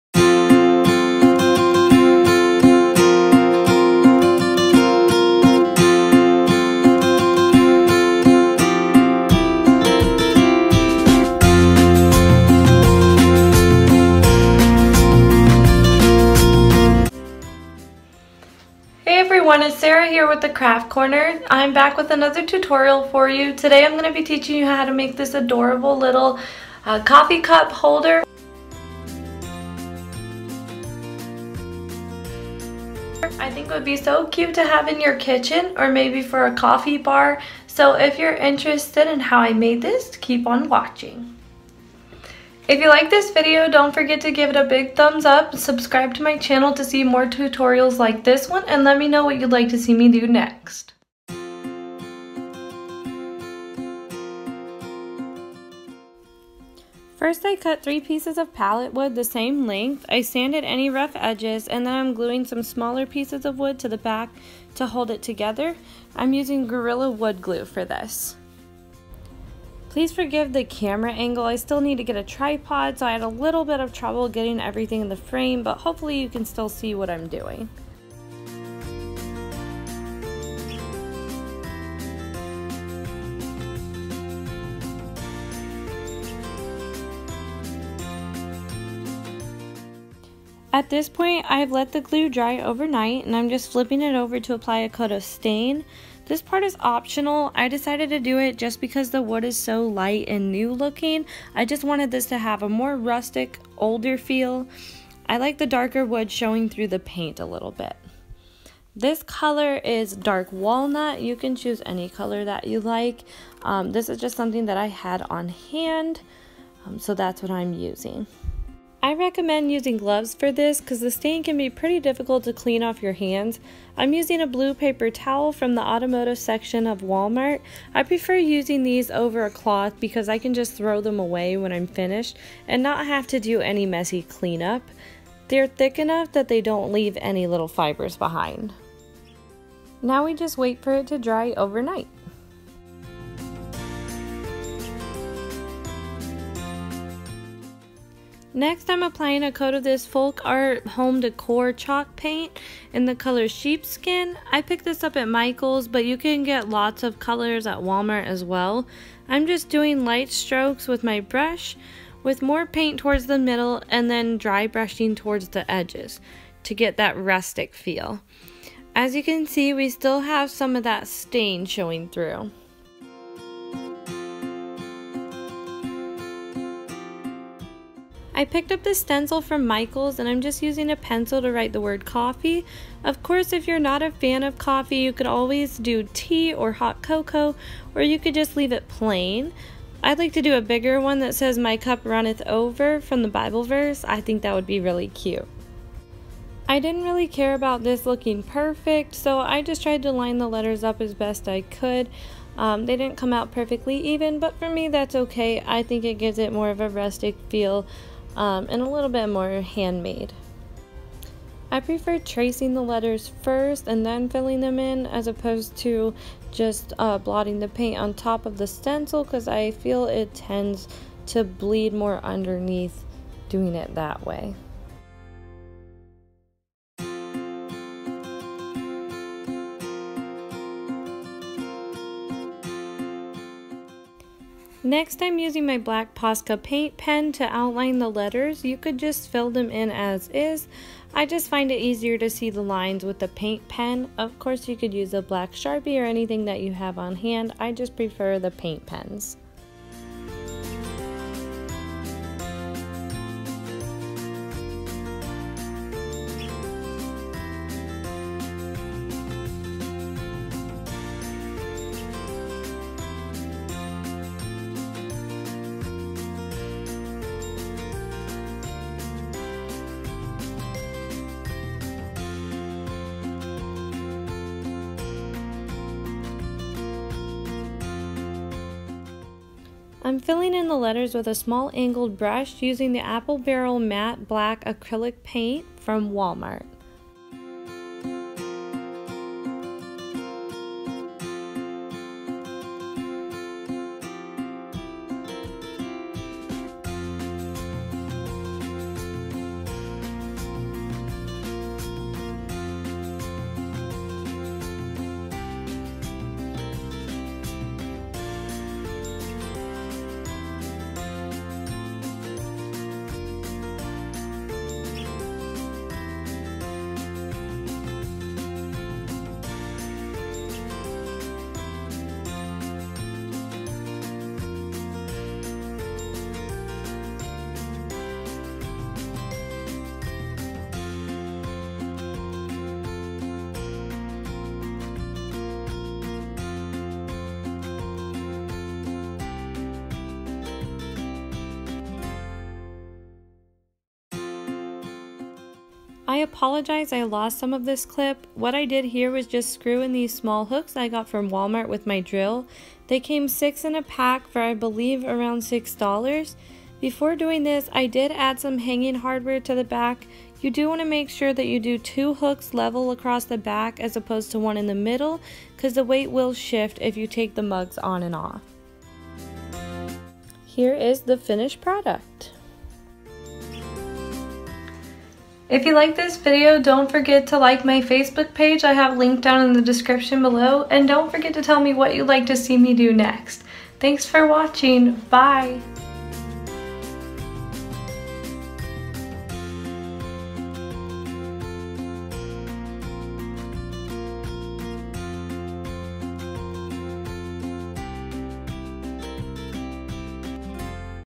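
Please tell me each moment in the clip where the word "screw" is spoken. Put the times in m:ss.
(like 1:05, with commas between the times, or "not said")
5:49.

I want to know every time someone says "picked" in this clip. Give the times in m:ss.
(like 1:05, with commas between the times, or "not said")
2:34, 2:58.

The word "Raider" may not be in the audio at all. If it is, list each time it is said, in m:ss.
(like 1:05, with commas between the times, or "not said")
not said.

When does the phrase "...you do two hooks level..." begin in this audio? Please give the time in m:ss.
6:01.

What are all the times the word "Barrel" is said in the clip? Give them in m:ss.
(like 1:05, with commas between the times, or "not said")
4:43.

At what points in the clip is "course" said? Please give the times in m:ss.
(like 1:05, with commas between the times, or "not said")
3:03, 4:04.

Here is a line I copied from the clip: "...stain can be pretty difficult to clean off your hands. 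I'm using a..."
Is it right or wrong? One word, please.
right.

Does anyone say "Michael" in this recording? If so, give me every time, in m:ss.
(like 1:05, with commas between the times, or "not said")
2:35, 2:59.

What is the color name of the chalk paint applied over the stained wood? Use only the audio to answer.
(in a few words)
Sheepskin.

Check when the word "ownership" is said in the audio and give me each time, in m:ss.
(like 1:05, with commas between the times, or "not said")
not said.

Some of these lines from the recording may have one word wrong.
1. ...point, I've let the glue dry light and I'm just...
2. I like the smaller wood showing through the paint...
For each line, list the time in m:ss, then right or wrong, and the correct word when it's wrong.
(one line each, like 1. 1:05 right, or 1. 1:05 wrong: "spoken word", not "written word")
1. 1:31 wrong: "overnight", not "light"
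2. 1:45 wrong: "darker", not "smaller".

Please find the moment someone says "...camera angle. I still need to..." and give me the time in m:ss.
1:10.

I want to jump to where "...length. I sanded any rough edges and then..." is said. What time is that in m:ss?
0:59.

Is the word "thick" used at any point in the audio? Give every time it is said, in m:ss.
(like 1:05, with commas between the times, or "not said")
2:15.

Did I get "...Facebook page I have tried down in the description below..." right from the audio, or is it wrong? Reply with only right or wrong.
wrong.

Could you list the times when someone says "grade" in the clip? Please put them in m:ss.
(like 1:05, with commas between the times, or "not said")
not said.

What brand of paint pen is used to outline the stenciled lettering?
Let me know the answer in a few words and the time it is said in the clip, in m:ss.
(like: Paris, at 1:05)
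Posca, at 3:56.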